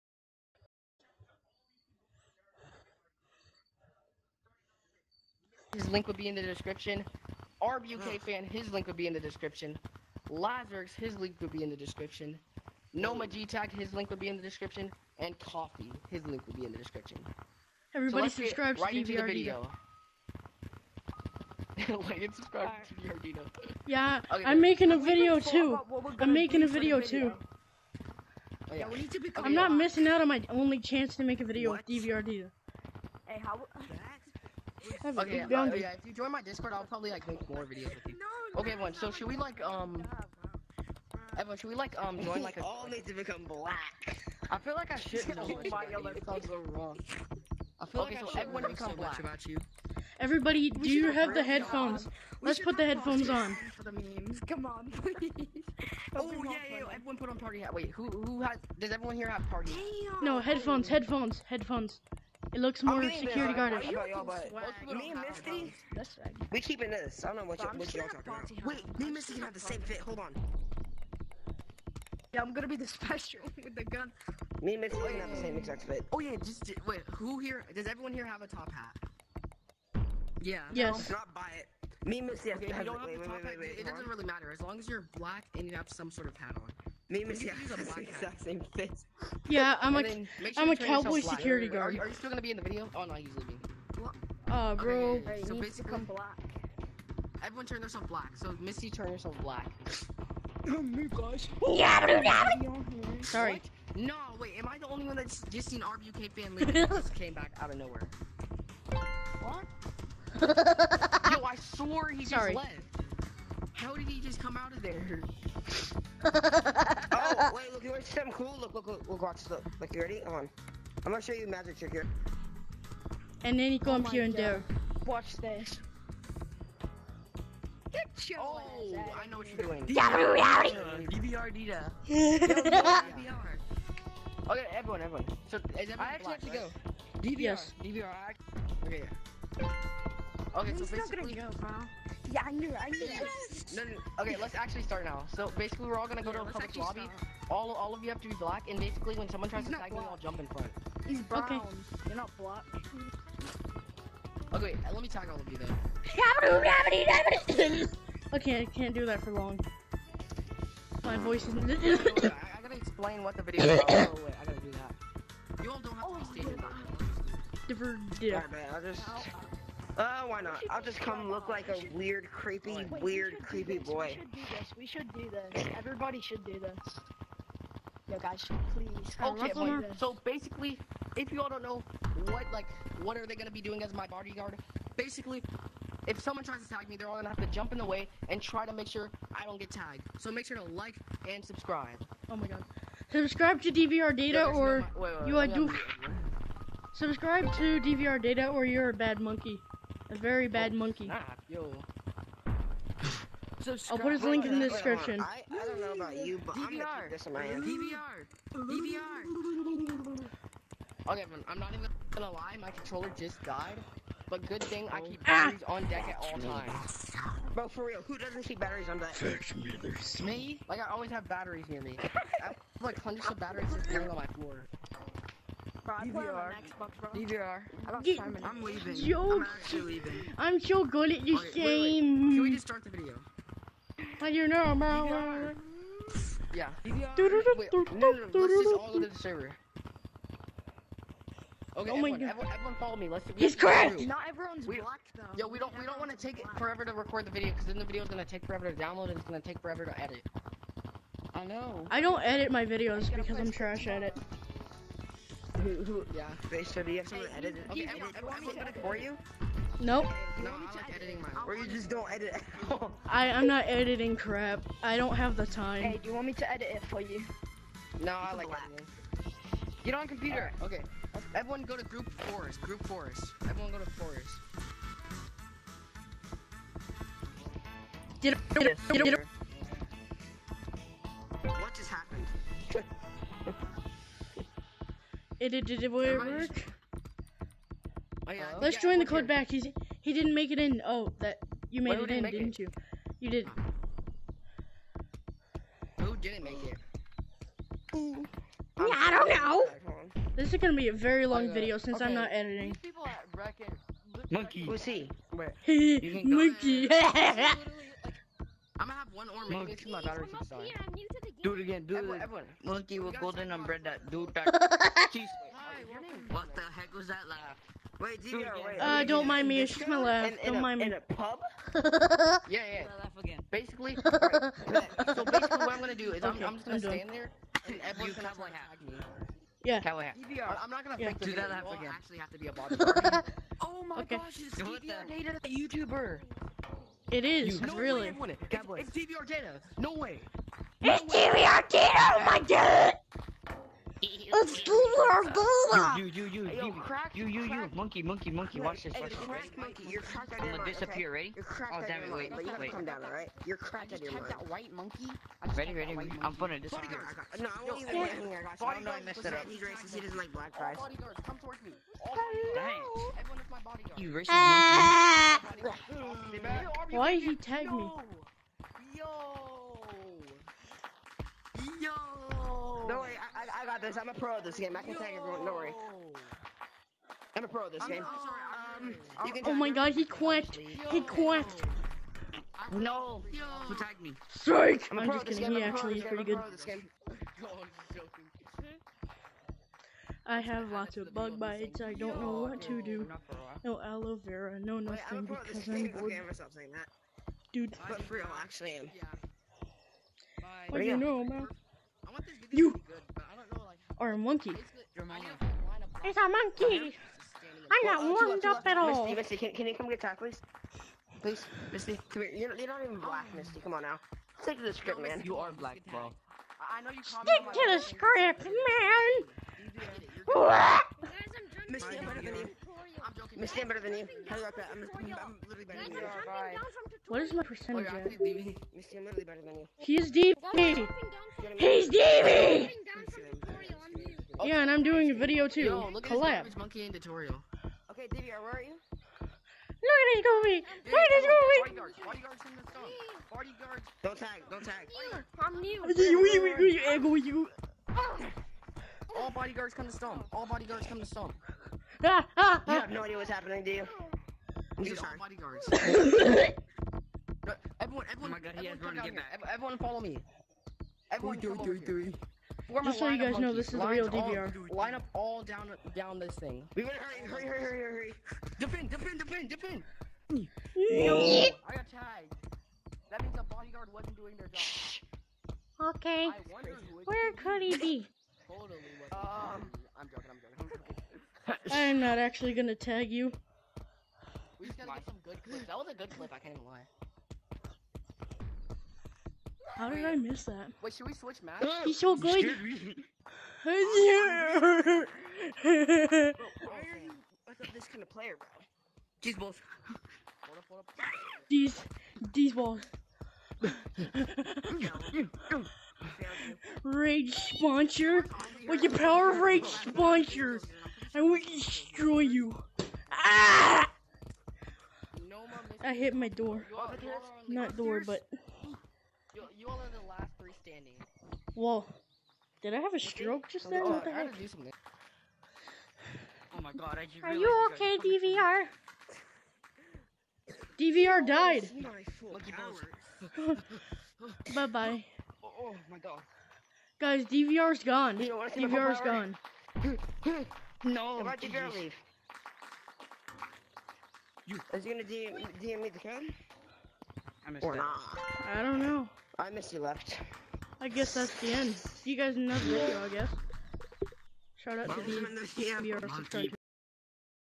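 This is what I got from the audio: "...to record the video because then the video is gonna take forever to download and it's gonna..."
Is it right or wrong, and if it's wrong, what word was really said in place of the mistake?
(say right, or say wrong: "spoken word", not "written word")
right.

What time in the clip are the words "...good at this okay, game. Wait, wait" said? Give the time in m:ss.
3:50.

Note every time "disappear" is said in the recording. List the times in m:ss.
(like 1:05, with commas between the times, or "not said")
5:50, 5:56.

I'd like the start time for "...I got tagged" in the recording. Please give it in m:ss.
7:50.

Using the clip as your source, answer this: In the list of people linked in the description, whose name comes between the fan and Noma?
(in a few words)
Lazarus.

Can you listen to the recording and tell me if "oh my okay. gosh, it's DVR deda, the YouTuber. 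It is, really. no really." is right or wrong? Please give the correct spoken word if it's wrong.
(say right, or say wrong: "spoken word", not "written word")
right.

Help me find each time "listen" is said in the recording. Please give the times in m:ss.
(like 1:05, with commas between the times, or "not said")
not said.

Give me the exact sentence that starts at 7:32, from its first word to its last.
You have no idea what's happening, do you?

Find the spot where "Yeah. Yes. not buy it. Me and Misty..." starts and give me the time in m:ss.
1:20.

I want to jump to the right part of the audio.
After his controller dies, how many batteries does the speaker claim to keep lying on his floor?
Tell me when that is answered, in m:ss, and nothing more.
3:43.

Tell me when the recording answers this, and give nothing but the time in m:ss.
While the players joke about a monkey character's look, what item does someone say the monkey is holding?
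5:13.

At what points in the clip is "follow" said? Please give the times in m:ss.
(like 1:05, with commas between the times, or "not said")
4:02, 7:39.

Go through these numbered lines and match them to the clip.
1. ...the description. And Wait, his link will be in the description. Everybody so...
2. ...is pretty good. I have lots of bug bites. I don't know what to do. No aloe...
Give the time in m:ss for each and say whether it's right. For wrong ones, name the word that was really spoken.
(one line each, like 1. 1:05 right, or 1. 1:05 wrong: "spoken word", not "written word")
1. 0:14 wrong: "Coffee", not "Wait"
2. 6:25 right.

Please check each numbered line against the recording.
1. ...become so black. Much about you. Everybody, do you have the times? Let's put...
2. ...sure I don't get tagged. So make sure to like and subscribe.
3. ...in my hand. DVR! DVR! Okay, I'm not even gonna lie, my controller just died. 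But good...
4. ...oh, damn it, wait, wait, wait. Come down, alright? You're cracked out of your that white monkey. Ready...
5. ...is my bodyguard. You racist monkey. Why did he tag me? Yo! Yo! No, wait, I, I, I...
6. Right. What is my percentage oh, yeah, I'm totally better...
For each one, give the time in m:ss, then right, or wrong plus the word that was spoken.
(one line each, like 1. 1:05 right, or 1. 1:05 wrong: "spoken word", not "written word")
1. 0:48 wrong: "headphones", not "times"
2. 3:08 right
3. 3:27 right
4. 5:51 right
5. 6:03 right
6. 7:06 wrong: "literally", not "totally".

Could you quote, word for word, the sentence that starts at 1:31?
Are, are, you still gonna be in the video?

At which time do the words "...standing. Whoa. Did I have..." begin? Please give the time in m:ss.
8:40.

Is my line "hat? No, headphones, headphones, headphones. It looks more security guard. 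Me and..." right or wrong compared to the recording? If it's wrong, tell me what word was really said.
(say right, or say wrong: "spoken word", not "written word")
right.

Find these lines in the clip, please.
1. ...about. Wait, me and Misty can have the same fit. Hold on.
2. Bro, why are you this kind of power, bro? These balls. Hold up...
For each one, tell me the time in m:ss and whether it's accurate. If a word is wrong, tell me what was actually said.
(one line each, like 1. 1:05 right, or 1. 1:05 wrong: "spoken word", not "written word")
1. 1:08 right
2. 8:12 wrong: "player", not "power".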